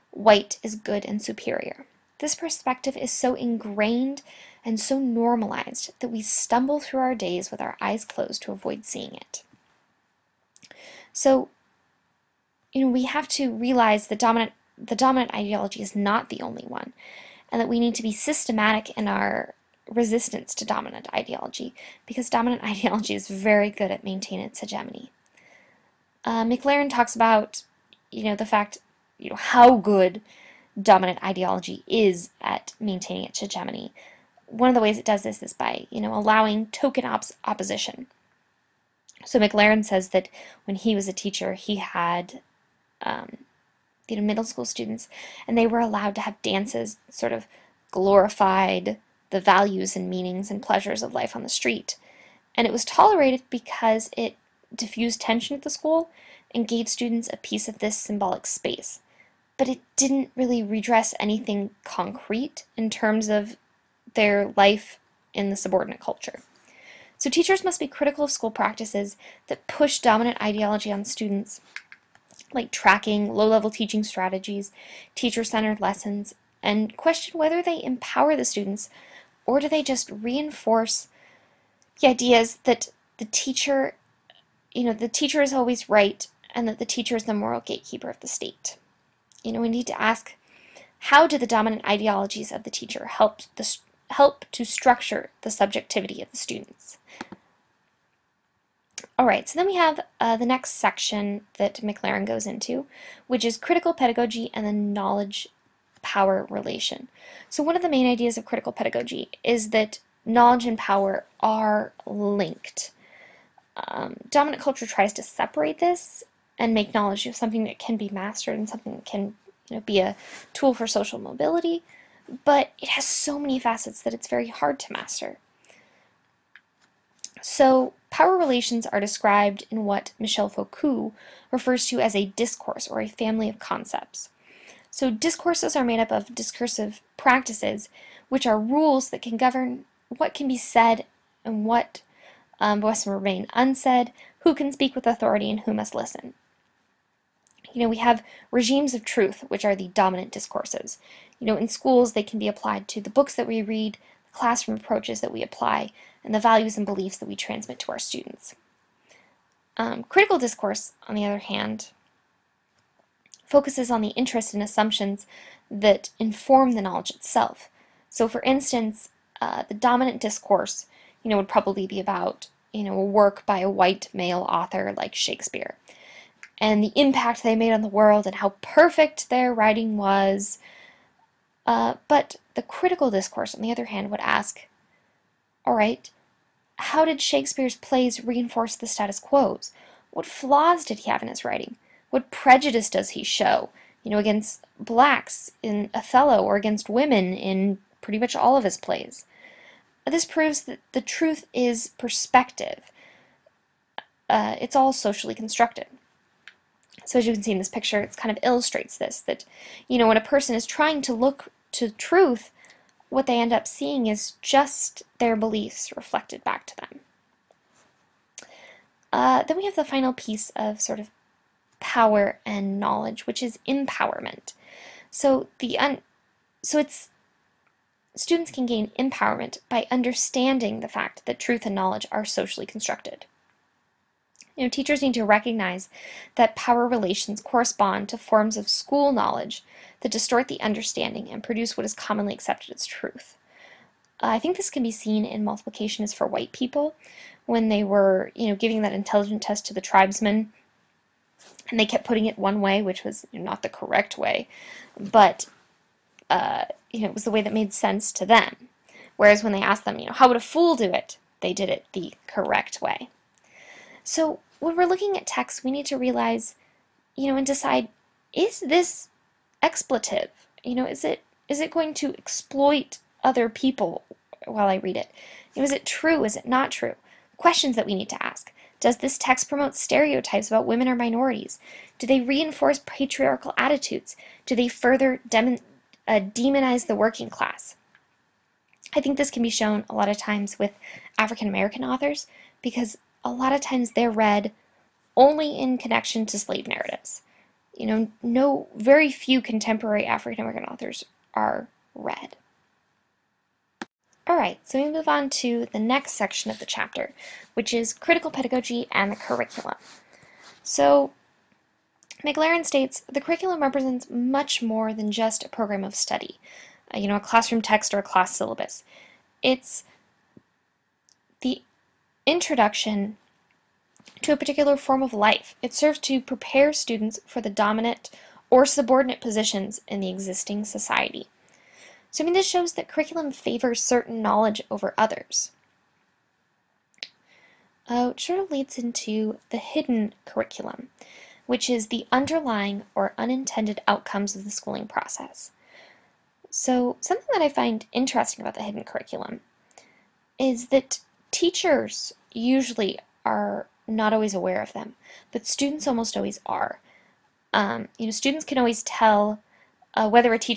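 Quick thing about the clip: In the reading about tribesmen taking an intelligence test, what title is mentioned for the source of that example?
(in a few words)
Multiplication Is for White People.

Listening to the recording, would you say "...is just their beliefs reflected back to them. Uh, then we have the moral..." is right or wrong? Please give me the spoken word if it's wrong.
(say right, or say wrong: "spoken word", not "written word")
wrong: "final", not "moral".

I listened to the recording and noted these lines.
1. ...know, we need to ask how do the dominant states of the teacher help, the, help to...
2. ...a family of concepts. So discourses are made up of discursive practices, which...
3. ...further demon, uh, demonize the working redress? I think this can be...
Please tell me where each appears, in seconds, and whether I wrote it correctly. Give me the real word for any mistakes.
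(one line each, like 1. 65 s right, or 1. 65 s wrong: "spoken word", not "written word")
1. 89 s wrong: "ideologies", not "states"
2. 133 s right
3. 284 s wrong: "class", not "redress".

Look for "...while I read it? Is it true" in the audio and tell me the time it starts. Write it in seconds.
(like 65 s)
274 s.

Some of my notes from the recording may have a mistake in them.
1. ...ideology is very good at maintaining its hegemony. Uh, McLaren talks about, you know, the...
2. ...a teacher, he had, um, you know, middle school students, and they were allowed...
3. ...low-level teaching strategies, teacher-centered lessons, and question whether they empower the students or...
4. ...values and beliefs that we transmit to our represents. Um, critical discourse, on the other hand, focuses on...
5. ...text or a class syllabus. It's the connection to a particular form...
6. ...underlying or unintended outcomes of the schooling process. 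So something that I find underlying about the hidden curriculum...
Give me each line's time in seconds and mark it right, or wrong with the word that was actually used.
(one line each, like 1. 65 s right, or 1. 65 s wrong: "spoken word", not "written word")
1. 22 s right
2. 41 s right
3. 73 s right
4. 156 s wrong: "students", not "represents"
5. 317 s wrong: "introduction", not "connection"
6. 342 s wrong: "interesting", not "underlying".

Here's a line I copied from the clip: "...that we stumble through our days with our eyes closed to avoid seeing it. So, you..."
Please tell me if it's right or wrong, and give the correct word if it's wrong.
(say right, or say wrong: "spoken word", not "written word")
right.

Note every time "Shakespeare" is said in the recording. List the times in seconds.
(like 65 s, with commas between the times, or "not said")
175 s, 187 s.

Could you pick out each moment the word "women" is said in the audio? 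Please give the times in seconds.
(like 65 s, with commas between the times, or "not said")
196 s, 280 s.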